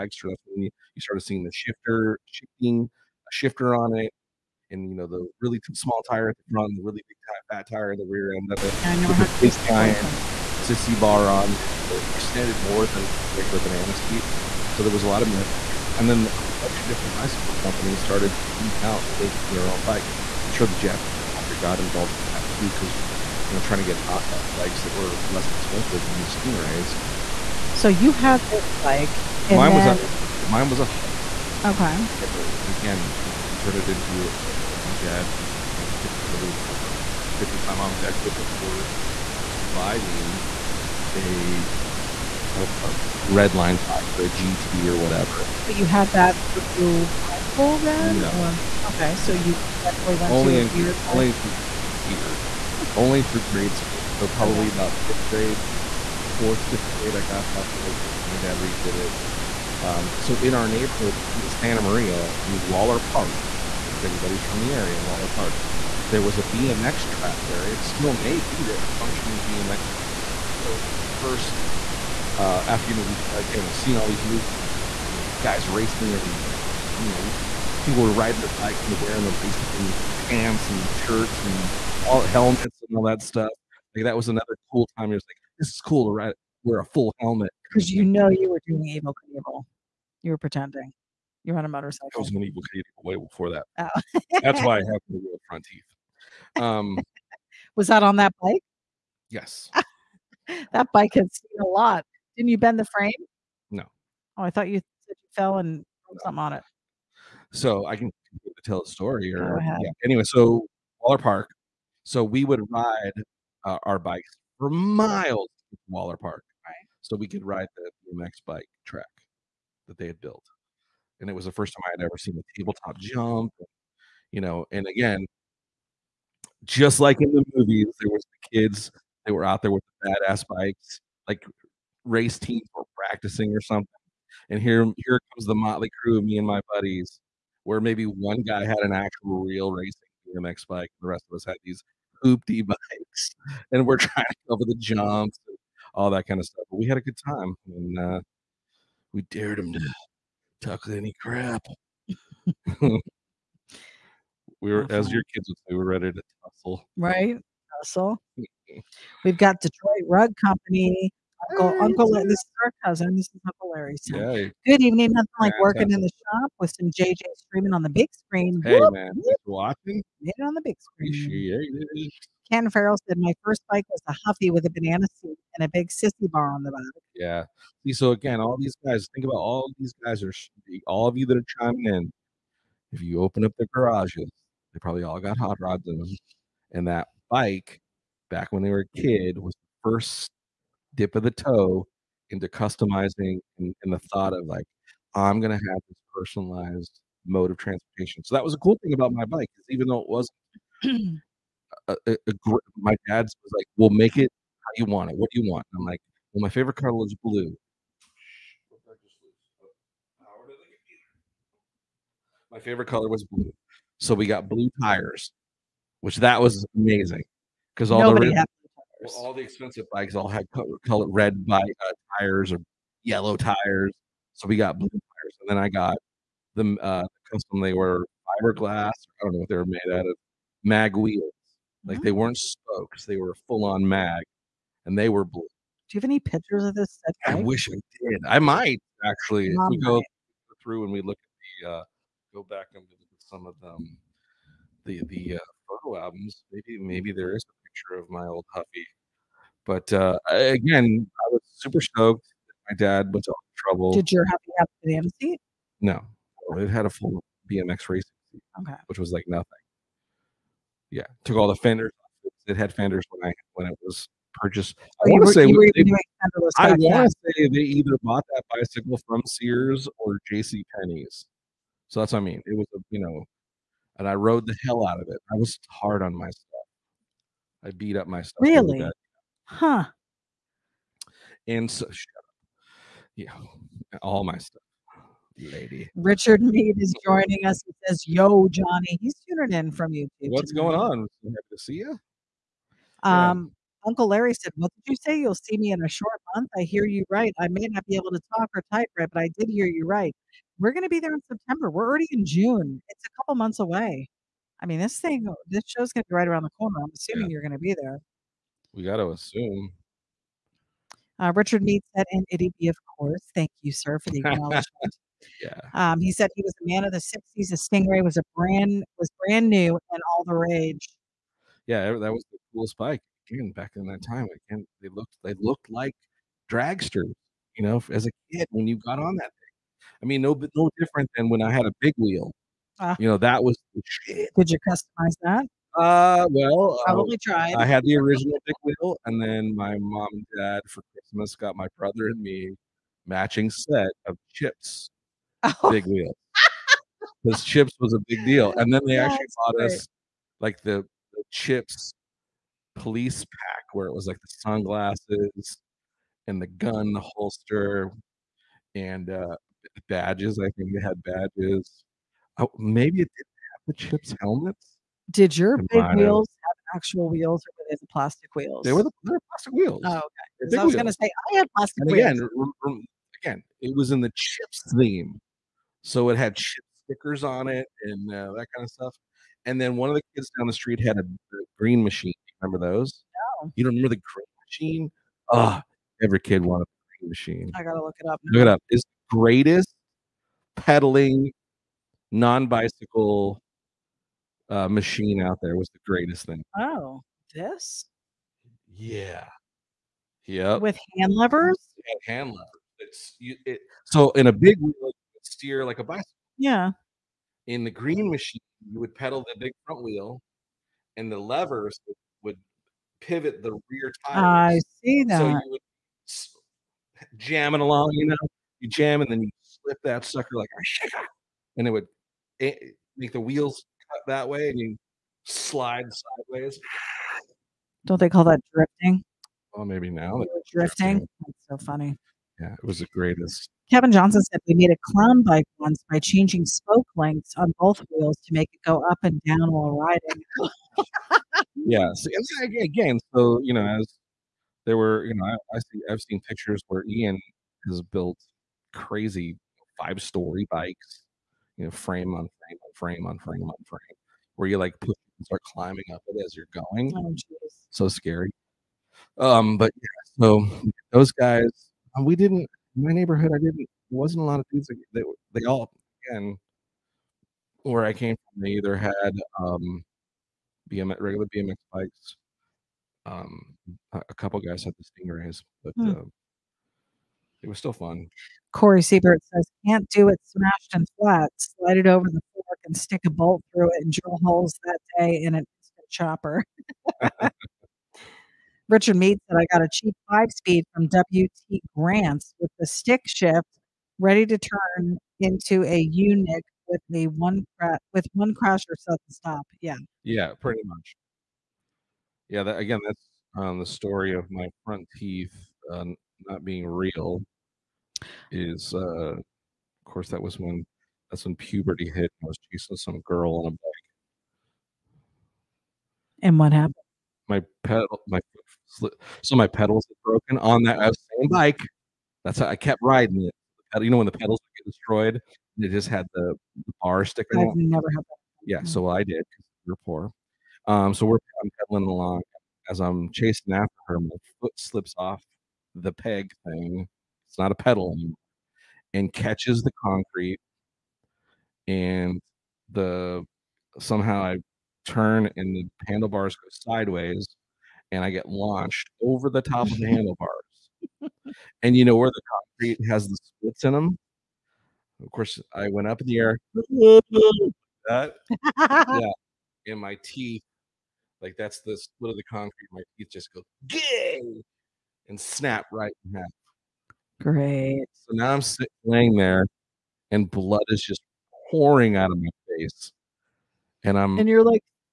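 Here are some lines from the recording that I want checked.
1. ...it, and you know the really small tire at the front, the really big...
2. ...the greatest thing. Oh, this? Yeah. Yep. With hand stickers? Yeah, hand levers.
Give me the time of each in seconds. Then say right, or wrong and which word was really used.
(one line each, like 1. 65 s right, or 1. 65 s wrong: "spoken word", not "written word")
1. 3 s right
2. 395 s wrong: "levers", not "stickers".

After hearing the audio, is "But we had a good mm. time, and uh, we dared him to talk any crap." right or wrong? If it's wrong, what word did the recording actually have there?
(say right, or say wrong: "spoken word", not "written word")
right.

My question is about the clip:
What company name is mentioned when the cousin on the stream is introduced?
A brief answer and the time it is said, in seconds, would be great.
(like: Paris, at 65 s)
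Detroit Rug Company, at 159 s.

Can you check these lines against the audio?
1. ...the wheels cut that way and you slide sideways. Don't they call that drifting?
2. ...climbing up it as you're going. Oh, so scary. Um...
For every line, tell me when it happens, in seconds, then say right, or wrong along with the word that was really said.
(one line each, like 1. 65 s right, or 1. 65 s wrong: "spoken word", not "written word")
1. 423 s right
2. 455 s right.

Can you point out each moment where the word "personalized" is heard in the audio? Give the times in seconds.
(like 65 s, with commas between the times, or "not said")
196 s.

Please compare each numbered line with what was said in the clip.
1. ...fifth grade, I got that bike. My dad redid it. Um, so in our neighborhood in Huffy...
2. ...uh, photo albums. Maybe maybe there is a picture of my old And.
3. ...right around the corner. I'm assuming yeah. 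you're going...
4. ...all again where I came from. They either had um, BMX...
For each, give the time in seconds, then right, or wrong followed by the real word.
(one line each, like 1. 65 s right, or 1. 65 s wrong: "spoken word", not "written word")
1. 56 s wrong: "Santa", not "Huffy"
2. 245 s wrong: "Huffy", not "And"
3. 306 s right
4. 465 s right.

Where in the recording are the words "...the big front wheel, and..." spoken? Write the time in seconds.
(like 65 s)
409 s.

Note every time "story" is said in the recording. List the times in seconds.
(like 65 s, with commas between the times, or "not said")
108 s, 450 s, 503 s.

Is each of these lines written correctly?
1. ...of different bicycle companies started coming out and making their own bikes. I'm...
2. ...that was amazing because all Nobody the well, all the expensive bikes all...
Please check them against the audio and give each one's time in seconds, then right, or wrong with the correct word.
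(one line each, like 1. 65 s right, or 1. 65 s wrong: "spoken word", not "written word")
1. 16 s right
2. 216 s right.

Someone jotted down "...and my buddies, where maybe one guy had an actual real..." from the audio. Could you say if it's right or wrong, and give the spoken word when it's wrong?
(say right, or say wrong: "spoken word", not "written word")
right.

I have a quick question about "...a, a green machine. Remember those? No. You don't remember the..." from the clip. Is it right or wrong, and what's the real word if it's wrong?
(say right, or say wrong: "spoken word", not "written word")
right.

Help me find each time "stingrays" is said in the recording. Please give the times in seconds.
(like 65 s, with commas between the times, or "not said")
26 s, 317 s, 474 s.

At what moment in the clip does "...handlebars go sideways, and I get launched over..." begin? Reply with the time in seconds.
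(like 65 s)
545 s.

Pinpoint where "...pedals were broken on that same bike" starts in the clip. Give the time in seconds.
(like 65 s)
519 s.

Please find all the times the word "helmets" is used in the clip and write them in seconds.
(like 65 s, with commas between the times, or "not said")
82 s, 87 s, 364 s.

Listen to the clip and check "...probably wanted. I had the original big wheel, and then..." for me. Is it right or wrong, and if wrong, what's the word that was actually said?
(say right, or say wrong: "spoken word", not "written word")
wrong: "tried", not "wanted".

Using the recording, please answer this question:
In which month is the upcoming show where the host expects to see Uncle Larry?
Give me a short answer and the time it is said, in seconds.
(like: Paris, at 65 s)
September, at 301 s.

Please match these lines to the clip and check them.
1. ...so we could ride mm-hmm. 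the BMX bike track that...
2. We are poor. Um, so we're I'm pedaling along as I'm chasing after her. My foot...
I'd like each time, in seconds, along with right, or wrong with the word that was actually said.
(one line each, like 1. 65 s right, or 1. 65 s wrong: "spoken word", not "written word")
1. 117 s right
2. 529 s right.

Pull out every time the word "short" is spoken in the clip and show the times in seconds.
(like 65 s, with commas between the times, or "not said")
295 s.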